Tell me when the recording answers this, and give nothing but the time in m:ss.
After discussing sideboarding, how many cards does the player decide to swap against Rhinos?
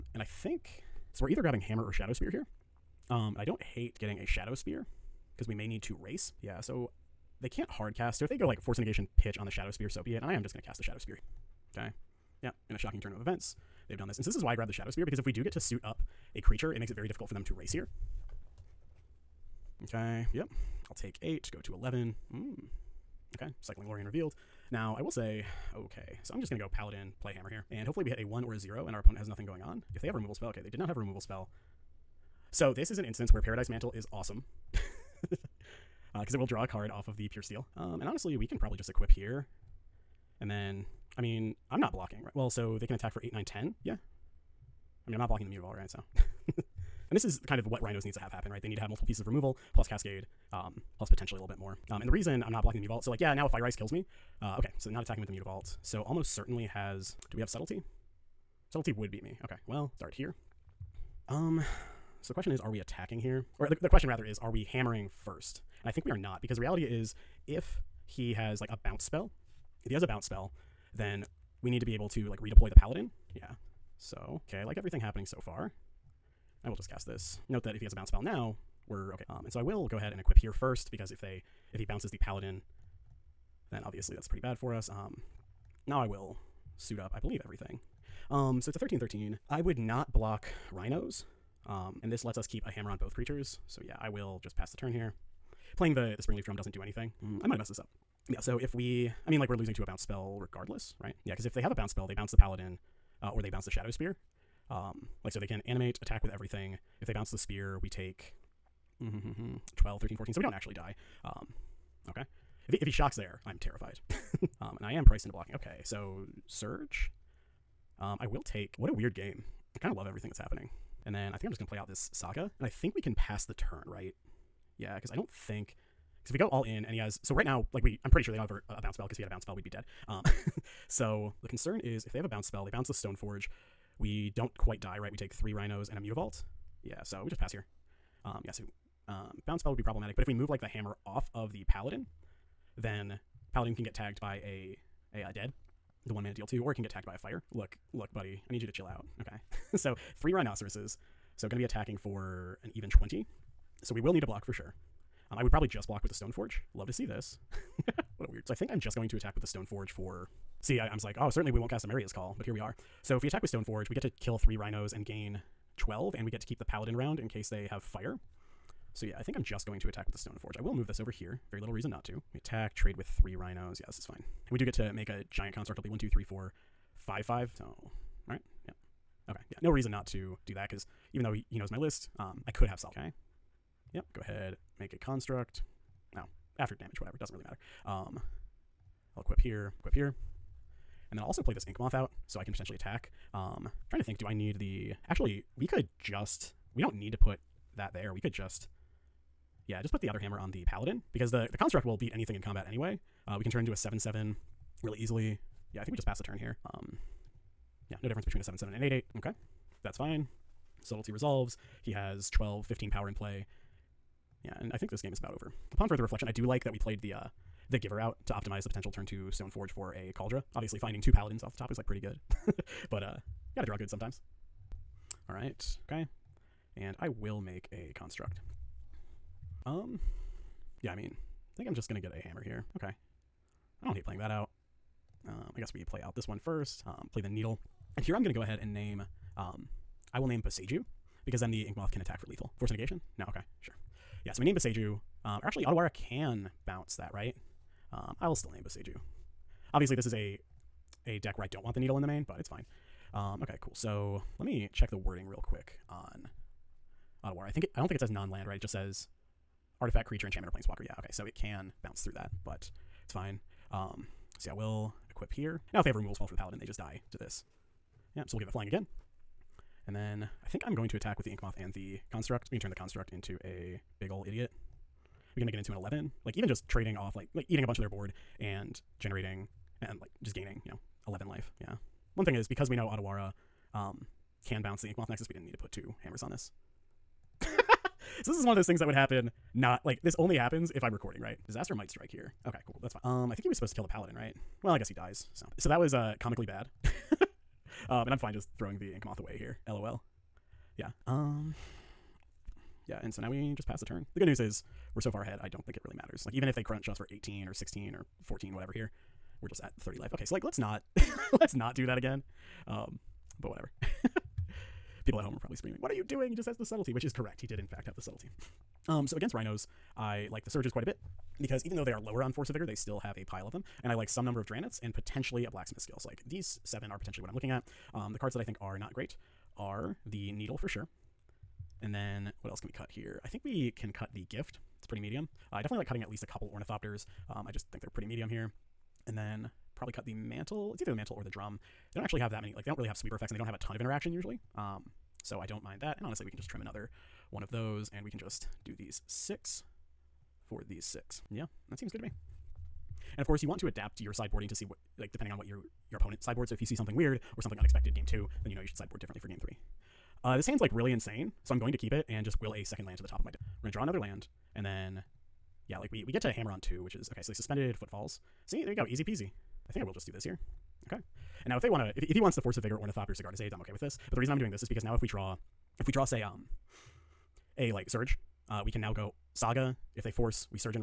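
5:48.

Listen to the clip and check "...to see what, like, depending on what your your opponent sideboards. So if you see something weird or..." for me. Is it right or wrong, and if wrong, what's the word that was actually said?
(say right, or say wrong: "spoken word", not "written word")
right.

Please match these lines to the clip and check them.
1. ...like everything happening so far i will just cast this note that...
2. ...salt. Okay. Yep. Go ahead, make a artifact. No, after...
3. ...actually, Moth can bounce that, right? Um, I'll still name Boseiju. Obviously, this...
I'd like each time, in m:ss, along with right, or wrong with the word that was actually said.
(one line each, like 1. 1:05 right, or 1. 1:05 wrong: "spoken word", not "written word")
1. 1:14 right
2. 3:02 wrong: "construct", not "artifact"
3. 4:05 wrong: "Otawara", not "Moth".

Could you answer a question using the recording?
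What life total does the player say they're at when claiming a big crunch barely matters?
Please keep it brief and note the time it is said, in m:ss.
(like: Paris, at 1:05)
30, at 5:09.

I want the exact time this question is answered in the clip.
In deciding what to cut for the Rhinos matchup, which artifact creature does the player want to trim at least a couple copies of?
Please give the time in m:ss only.
5:36.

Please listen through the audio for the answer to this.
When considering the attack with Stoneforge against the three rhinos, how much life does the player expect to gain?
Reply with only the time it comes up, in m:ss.
2:45.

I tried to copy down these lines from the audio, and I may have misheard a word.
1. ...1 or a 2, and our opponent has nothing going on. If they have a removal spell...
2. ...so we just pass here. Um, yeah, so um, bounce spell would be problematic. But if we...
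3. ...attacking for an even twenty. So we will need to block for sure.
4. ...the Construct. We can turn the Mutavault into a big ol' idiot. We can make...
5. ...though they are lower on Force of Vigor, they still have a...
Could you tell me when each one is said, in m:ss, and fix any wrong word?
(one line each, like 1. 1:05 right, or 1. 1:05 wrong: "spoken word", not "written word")
1. 0:28 wrong: "0", not "2"
2. 2:17 right
3. 2:31 right
4. 4:31 wrong: "Construct", not "Mutavault"
5. 5:21 right.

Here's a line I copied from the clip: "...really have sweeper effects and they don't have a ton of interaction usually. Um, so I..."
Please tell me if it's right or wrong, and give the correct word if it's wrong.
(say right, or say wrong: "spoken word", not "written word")
right.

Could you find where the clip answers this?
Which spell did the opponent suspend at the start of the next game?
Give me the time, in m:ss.
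6:07.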